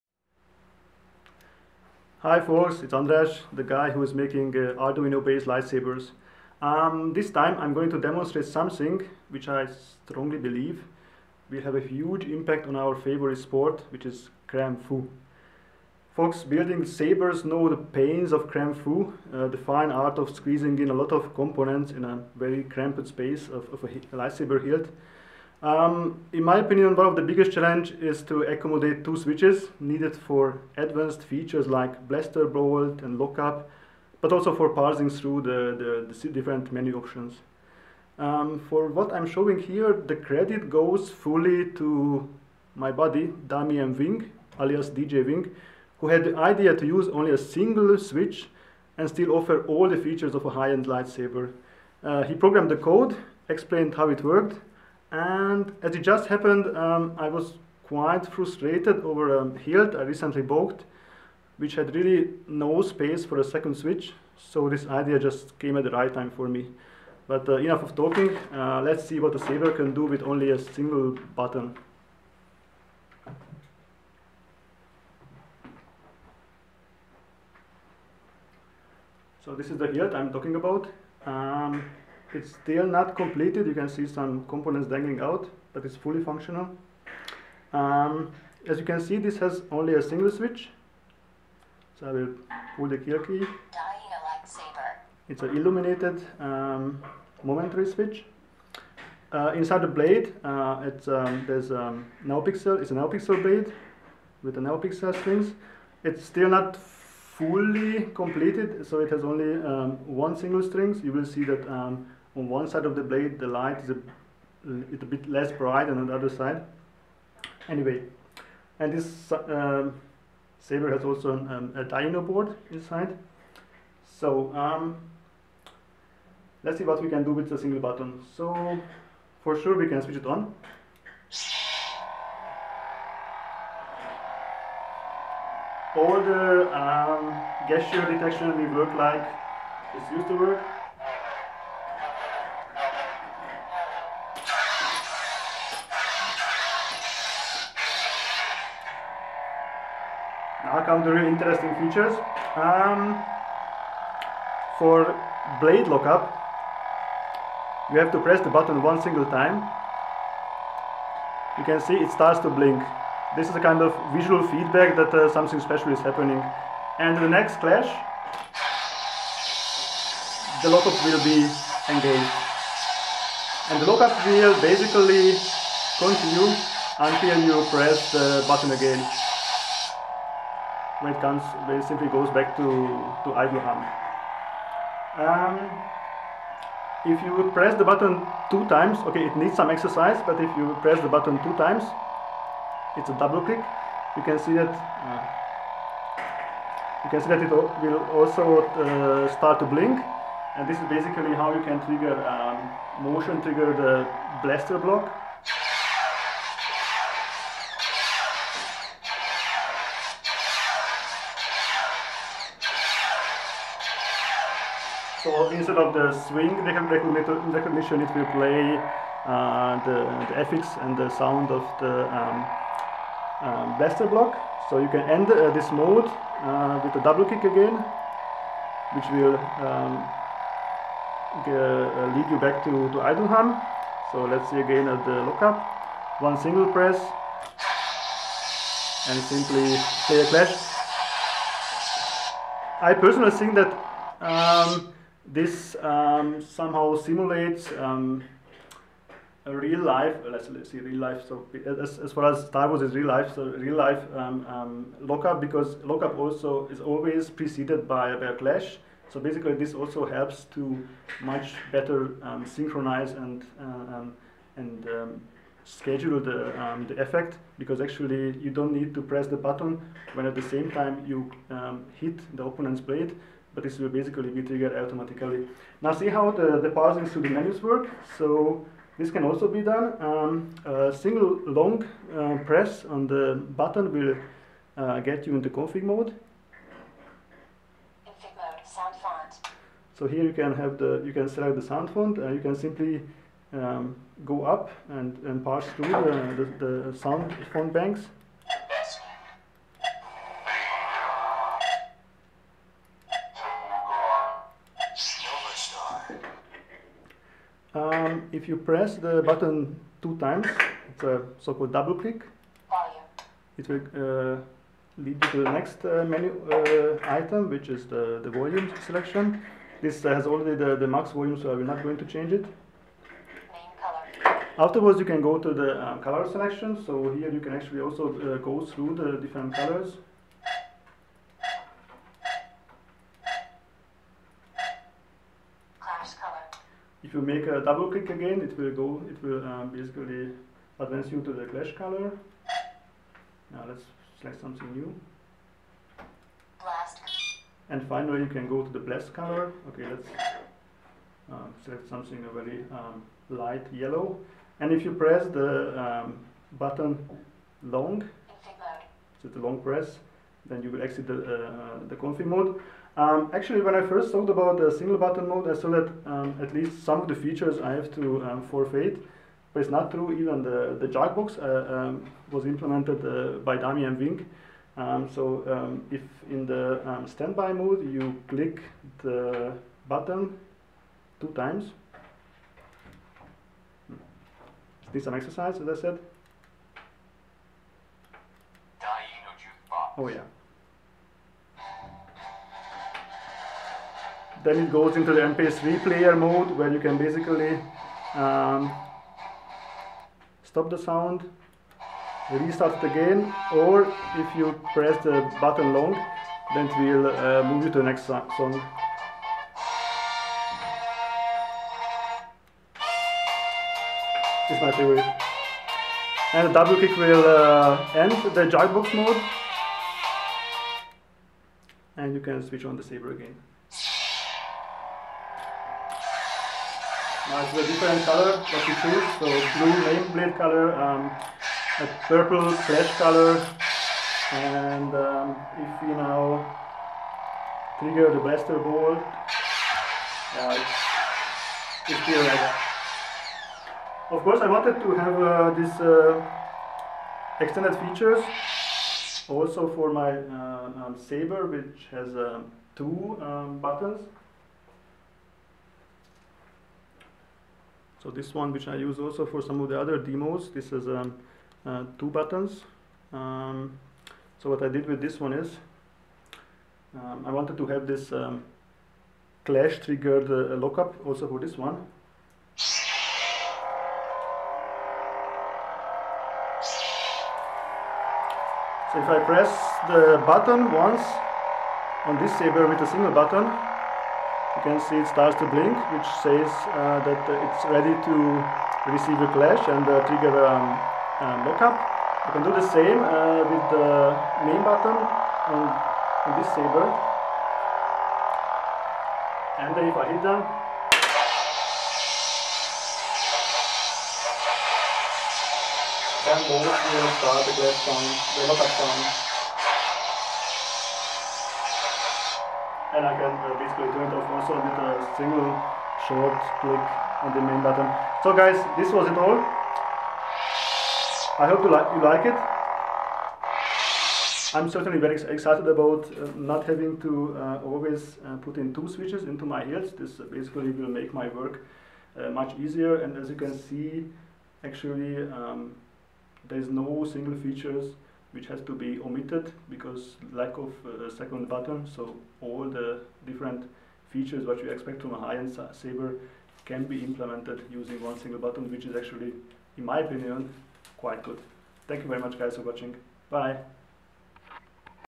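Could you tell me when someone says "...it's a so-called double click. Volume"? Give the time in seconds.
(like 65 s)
310 s.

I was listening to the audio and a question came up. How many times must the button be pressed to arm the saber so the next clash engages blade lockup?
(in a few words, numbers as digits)
1.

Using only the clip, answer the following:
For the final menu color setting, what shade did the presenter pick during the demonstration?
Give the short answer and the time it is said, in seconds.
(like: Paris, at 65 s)
light yellow, at 353 s.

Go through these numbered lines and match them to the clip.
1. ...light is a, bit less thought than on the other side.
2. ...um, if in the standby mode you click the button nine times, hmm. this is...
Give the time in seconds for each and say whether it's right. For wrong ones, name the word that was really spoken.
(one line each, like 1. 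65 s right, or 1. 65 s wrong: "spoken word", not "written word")
1. 113 s wrong: "bright", not "thought"
2. 375 s wrong: "two", not "nine".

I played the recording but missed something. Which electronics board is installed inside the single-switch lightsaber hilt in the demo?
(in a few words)
DIYino.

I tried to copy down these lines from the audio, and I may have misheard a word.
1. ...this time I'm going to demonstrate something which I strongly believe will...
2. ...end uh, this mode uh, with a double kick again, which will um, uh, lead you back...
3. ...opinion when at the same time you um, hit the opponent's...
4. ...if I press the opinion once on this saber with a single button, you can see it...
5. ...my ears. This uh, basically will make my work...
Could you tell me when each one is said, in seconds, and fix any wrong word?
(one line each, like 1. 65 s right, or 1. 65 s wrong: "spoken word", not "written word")
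1. 7 s right
2. 225 s right
3. 269 s wrong: "button", not "opinion"
4. 478 s wrong: "button", not "opinion"
5. 529 s right.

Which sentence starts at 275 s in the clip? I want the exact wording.
Now see how the, the parsing through the menus work.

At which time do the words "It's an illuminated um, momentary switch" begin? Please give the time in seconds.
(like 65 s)
95 s.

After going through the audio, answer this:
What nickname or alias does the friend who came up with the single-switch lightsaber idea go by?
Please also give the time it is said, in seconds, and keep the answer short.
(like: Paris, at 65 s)
DJ Wing, at 44 s.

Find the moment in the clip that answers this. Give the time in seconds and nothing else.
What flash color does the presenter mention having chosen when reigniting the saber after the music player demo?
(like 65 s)
432 s.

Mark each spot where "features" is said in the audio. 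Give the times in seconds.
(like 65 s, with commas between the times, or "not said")
31 s, 49 s, 151 s, 367 s, 447 s, 537 s, 544 s.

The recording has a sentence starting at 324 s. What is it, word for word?
Afterwards, you can go to the um, color selection.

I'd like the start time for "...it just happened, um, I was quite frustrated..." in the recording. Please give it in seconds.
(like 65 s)
55 s.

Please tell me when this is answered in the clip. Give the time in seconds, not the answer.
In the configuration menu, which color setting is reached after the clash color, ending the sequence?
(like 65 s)
348 s.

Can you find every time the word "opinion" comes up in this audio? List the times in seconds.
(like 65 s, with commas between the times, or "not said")
26 s, 549 s.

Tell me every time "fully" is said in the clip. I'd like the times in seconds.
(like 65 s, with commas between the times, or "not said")
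41 s, 85 s, 106 s.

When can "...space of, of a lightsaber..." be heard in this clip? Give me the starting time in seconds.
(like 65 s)
23 s.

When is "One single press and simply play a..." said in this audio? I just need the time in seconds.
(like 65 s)
236 s.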